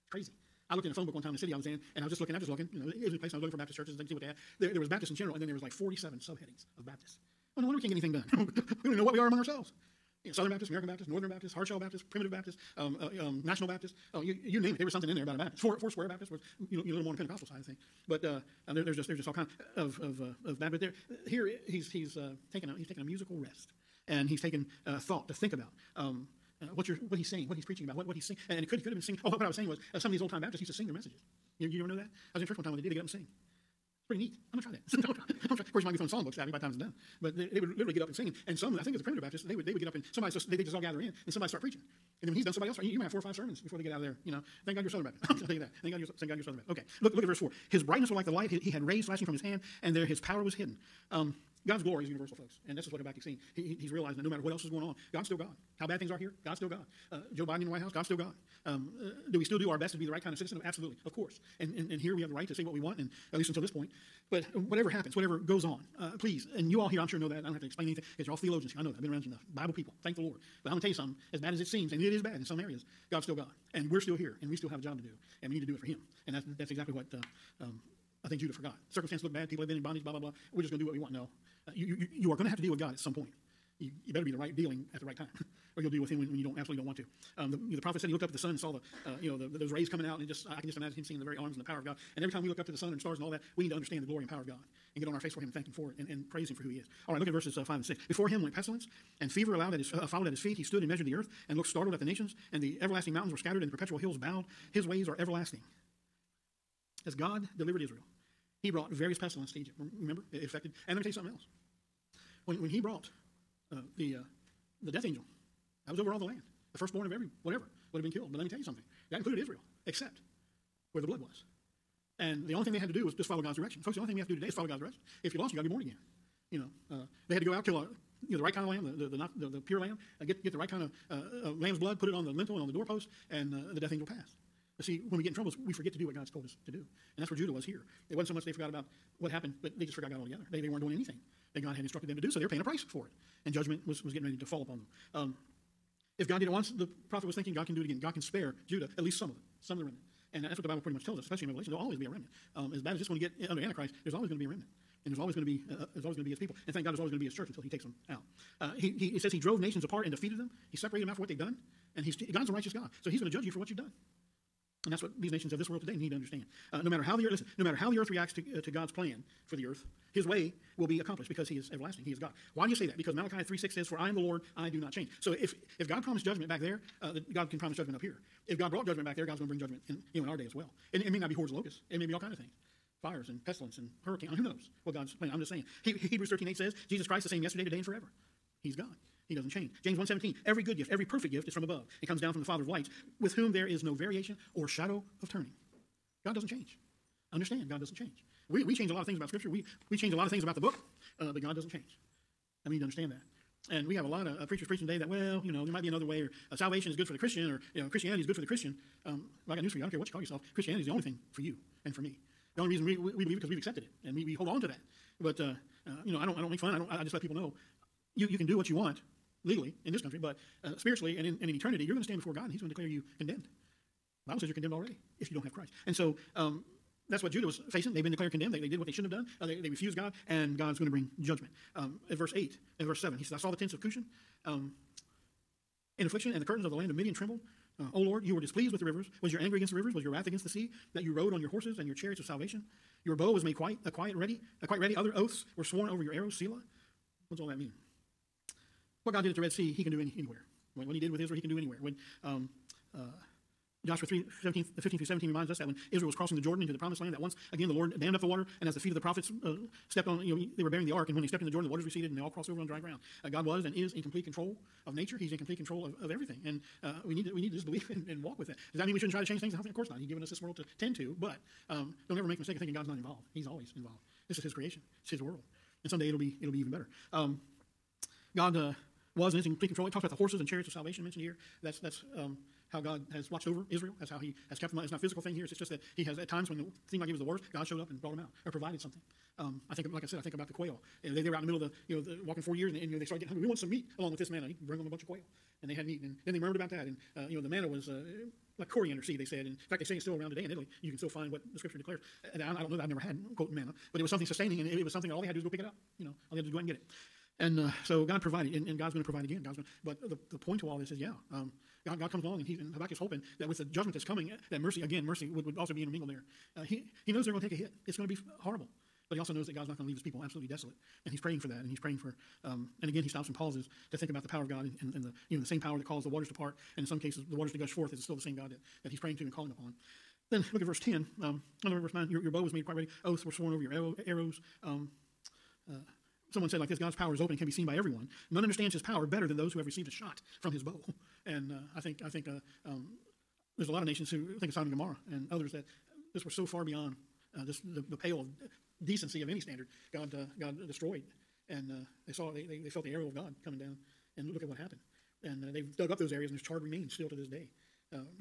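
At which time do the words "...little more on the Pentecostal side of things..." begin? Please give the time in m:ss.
0:16.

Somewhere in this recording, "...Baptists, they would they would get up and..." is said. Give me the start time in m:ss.
0:39.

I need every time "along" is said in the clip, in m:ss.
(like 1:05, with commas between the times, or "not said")
4:53, 5:12.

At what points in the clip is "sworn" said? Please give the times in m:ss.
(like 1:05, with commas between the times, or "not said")
4:05, 5:33.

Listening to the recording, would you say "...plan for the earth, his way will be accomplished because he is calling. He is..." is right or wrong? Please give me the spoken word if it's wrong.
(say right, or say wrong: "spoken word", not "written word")
wrong: "everlasting", not "calling".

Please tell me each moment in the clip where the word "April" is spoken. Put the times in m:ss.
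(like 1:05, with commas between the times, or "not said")
not said.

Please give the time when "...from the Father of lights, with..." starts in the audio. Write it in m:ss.
3:12.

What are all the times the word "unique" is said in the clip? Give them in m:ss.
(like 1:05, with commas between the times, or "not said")
not said.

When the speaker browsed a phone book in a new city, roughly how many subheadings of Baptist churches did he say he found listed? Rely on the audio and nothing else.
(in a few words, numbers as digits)
47.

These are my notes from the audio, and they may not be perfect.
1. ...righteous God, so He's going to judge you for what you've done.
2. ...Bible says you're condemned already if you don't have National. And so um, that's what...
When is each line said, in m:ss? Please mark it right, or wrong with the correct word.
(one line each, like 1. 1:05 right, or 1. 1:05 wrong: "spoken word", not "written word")
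1. 2:42 right
2. 3:44 wrong: "Christ", not "National".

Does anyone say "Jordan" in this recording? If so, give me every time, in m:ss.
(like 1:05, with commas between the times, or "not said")
4:16, 4:21.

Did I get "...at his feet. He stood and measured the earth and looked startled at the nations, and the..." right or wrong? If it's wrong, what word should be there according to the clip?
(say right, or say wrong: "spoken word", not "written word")
right.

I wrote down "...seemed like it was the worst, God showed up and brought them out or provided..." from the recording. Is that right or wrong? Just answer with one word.
right.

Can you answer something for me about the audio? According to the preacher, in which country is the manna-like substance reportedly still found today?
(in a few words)
Italy.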